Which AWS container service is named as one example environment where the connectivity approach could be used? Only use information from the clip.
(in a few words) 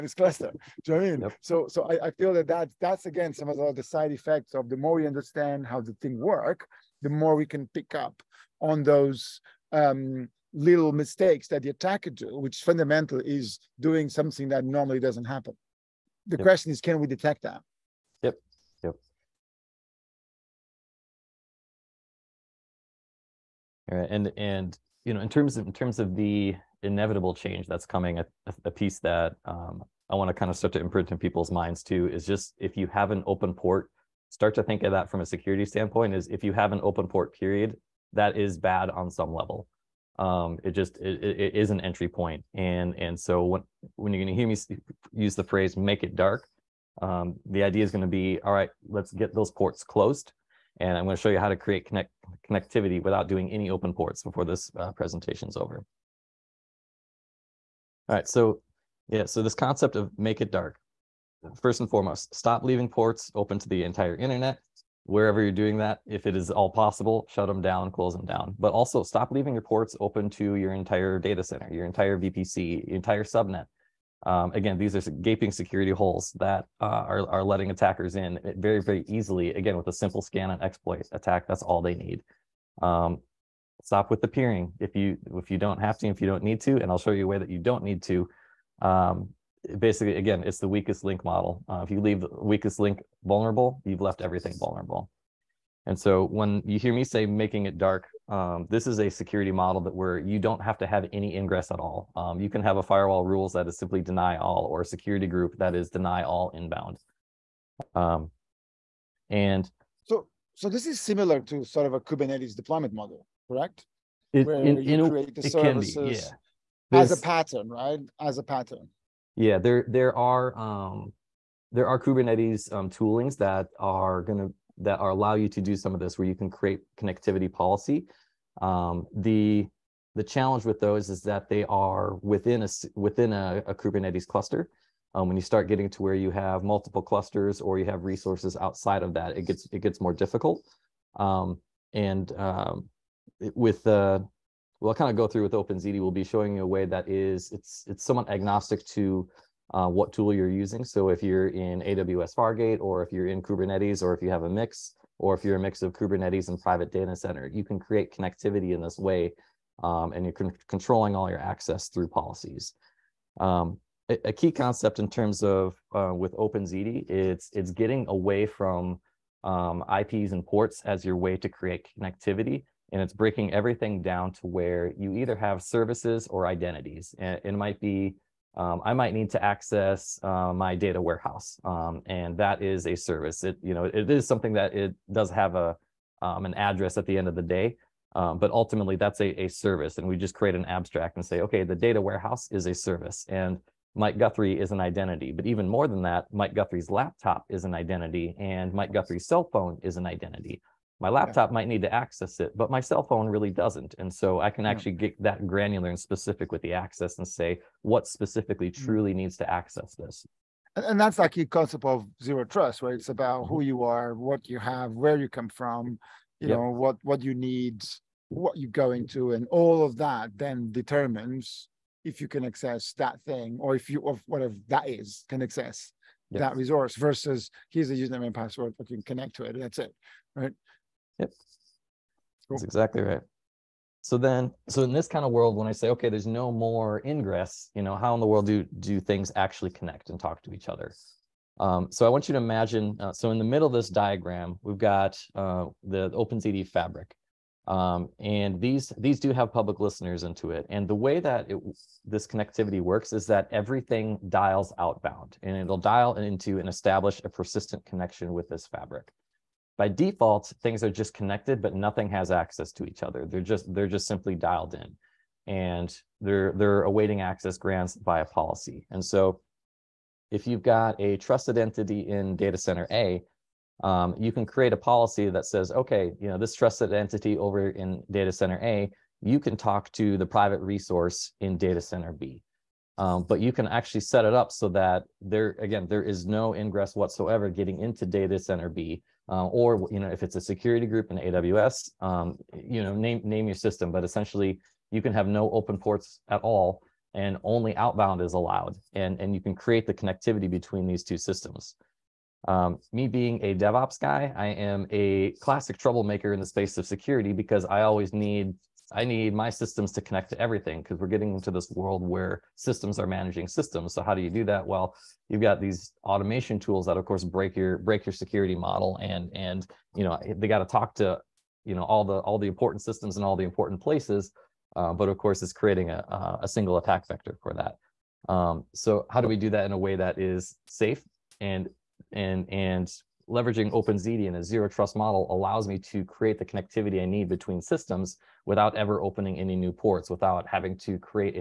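AWS Fargate.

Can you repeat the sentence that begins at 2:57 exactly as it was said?
And it might be um, I might need to access uh, my data warehouse.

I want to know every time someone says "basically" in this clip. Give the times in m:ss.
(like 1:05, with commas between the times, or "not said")
1:29.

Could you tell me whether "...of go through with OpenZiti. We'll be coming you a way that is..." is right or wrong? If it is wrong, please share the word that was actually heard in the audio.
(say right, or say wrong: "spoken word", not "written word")
wrong: "showing", not "coming".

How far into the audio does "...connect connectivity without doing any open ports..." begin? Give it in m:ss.
0:51.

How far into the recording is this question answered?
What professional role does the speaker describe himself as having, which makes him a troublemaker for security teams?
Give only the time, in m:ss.
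5:03.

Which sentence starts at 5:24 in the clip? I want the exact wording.
Uh, but of course, it's creating a a single attack vector for that.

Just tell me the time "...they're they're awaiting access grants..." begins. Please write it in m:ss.
4:26.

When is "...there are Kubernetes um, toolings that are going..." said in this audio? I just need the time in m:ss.
2:01.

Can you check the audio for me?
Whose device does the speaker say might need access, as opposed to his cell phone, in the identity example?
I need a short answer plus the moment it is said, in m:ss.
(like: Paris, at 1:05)
Mike Guthrie's laptop, at 3:16.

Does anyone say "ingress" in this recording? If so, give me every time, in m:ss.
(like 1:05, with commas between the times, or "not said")
1:41, 3:57, 4:46.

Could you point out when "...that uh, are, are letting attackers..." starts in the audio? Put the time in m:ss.
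1:16.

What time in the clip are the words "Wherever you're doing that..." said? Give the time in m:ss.
1:05.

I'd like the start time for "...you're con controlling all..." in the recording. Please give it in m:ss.
2:40.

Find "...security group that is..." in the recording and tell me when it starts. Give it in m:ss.
1:44.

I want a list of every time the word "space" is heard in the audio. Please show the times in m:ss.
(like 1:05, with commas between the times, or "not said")
5:06.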